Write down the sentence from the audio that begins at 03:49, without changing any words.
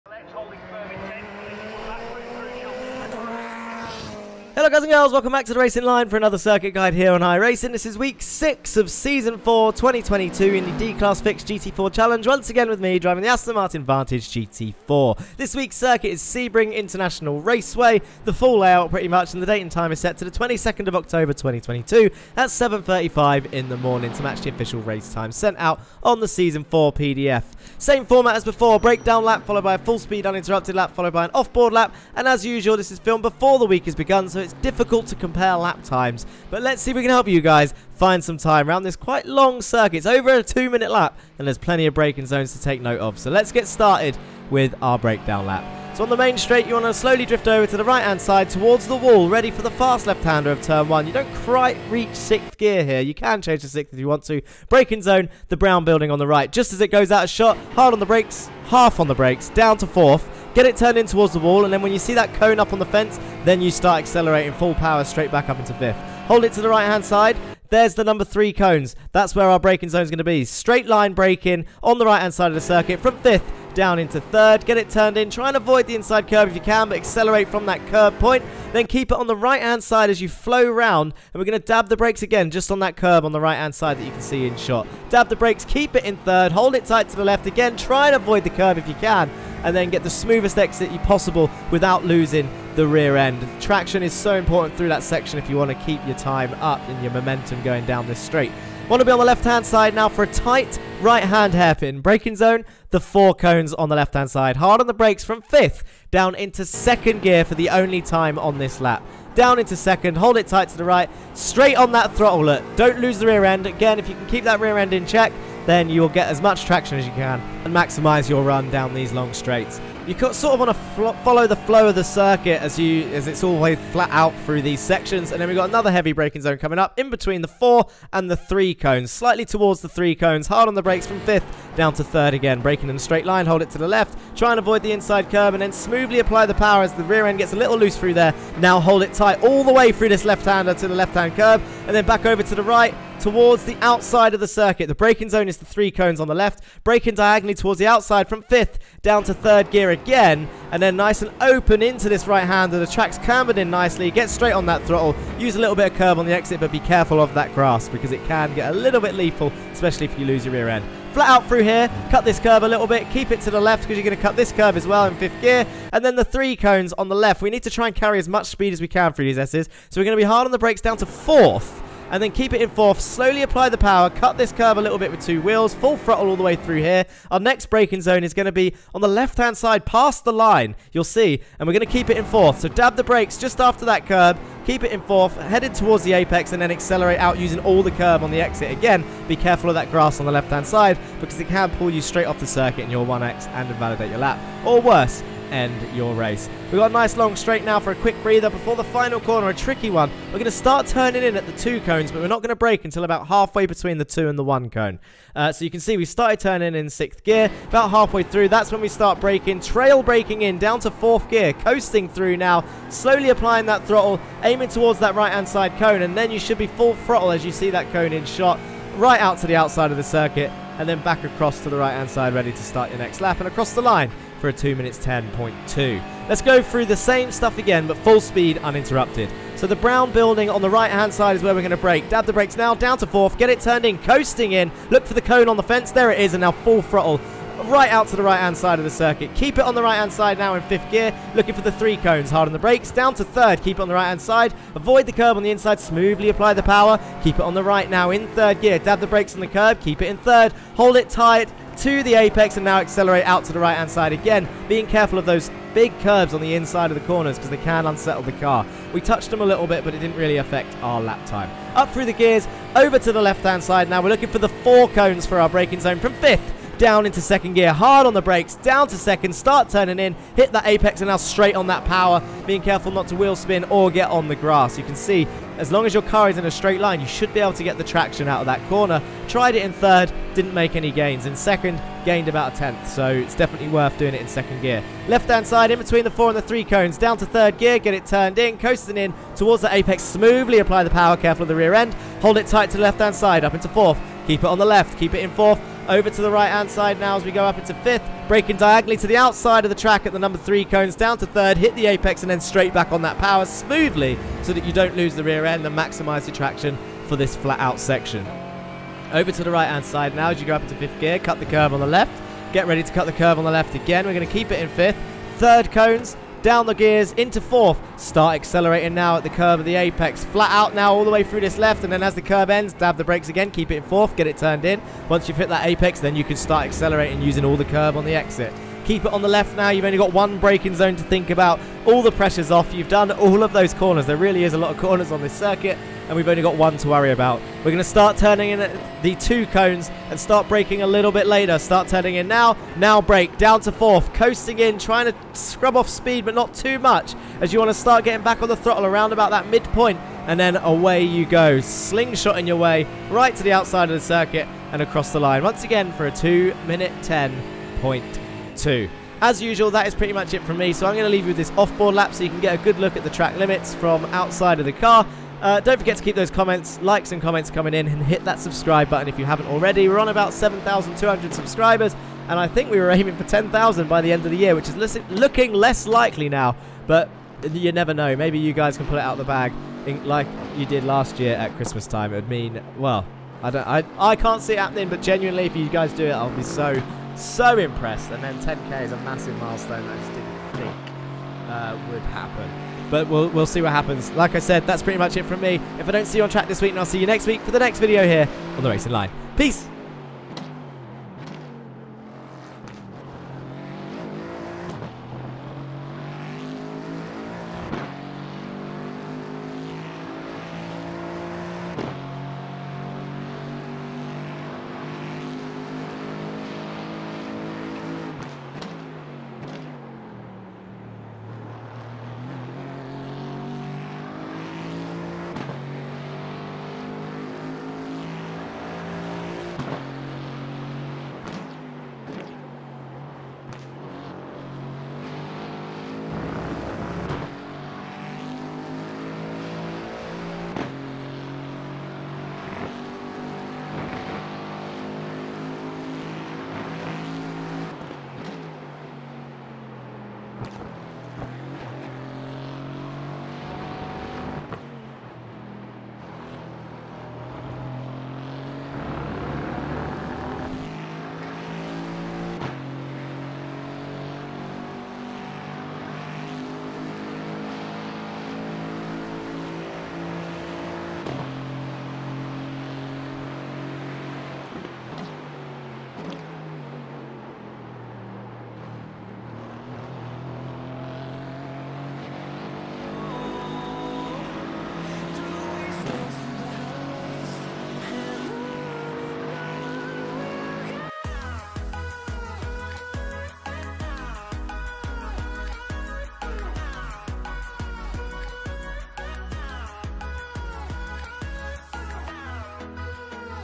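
So the brown building on the right-hand side is where we're going to brake.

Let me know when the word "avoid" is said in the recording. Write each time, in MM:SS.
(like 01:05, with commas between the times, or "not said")
01:15, 01:28, 02:14, 04:04.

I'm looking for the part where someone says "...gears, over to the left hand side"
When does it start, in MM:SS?
04:22.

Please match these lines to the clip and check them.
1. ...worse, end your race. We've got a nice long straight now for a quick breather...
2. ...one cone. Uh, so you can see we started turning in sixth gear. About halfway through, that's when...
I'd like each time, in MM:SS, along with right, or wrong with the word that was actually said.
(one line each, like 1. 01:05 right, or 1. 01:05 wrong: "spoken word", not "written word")
1. 03:14 right
2. 03:24 right.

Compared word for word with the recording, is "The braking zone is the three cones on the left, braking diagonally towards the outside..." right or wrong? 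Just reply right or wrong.
right.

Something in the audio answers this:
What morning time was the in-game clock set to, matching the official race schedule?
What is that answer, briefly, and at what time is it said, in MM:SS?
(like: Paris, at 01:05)
7.35, at 00:22.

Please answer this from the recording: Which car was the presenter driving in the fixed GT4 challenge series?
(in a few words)
Aston Martin Vantage GT4.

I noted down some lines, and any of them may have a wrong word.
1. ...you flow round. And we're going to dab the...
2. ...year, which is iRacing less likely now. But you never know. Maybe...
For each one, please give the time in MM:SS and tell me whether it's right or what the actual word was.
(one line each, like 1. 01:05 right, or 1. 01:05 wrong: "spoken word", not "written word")
1. 01:20 right
2. 06:14 wrong: "looking", not "iRacing".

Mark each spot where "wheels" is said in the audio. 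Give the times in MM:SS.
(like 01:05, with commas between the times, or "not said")
02:55, 04:33.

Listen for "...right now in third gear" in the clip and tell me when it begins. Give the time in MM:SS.
04:07.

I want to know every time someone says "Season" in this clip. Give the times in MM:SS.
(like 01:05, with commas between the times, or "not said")
00:08, 00:26.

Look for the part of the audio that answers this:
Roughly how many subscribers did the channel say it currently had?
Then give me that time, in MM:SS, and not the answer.
06:10.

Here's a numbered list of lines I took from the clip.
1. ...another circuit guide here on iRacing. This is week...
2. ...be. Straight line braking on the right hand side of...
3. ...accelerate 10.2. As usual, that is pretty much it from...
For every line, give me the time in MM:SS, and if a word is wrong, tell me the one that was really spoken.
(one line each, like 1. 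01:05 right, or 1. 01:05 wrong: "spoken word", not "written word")
1. 00:06 right
2. 01:10 right
3. 05:56 wrong: "minute", not "accelerate".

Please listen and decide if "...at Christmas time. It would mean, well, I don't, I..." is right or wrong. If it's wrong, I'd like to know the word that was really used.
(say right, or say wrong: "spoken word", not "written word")
right.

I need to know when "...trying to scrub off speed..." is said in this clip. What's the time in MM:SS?
05:44.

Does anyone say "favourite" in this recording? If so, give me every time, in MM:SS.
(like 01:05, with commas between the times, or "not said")
not said.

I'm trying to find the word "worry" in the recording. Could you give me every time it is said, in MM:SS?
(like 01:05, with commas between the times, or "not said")
05:36.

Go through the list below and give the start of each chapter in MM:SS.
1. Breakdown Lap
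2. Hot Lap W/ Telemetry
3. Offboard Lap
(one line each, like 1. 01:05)
1. 00:44
2. 03:10
3. 04:44.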